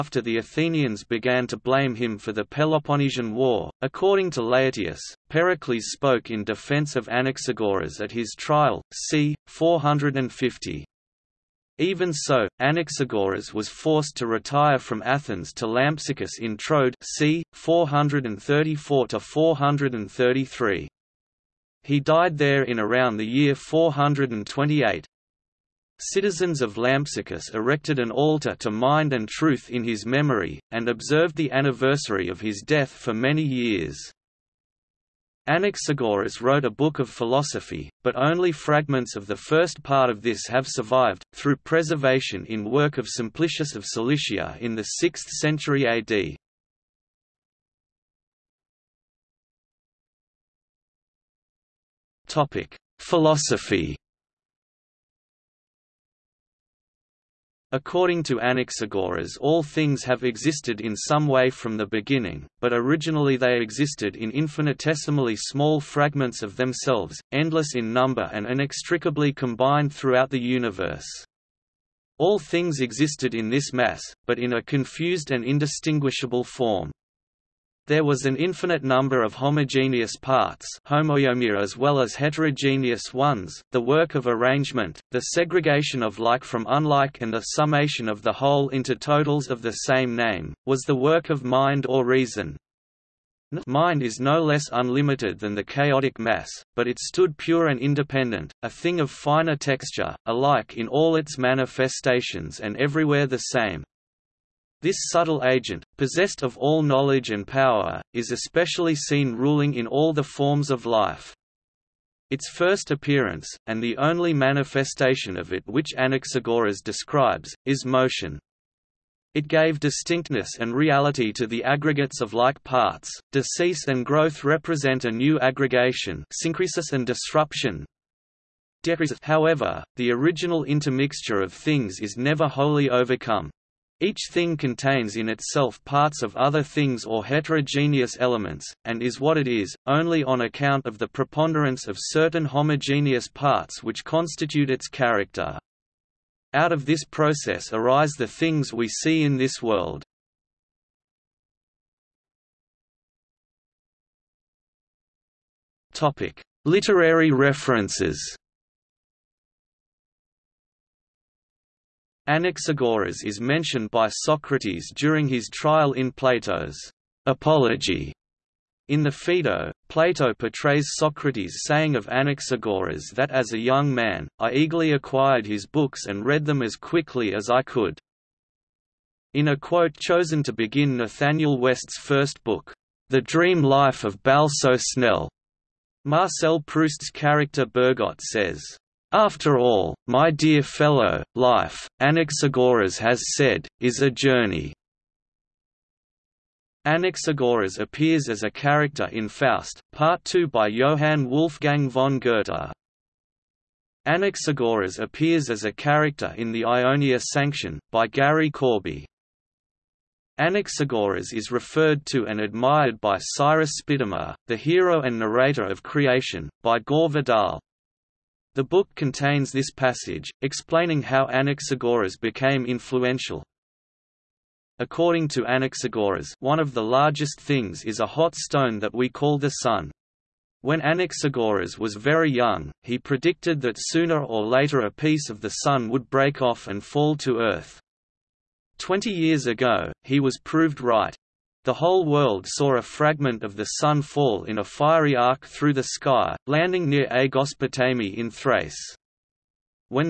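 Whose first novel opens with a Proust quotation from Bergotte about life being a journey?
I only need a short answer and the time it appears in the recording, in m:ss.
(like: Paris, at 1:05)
Nathanael West, at 3:00.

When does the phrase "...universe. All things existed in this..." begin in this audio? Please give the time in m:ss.
1:10.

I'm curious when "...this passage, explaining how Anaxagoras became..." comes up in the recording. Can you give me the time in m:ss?
3:39.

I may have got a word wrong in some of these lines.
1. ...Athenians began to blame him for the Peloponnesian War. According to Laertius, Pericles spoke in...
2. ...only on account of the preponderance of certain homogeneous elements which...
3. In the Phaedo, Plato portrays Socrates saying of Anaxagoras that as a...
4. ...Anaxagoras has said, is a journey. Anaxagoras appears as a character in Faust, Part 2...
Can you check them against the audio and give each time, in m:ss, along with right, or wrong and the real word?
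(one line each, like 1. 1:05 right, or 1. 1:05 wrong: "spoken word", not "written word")
1. 0:00 right
2. 2:19 wrong: "parts", not "elements"
3. 2:48 right
4. 3:12 right.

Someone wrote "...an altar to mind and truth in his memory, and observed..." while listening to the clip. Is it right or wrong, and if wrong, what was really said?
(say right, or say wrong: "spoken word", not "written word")
right.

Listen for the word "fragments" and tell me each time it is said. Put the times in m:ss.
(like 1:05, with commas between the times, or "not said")
0:38, 1:05, 4:02.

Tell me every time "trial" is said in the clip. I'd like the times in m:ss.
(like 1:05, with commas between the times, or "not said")
0:08, 2:45.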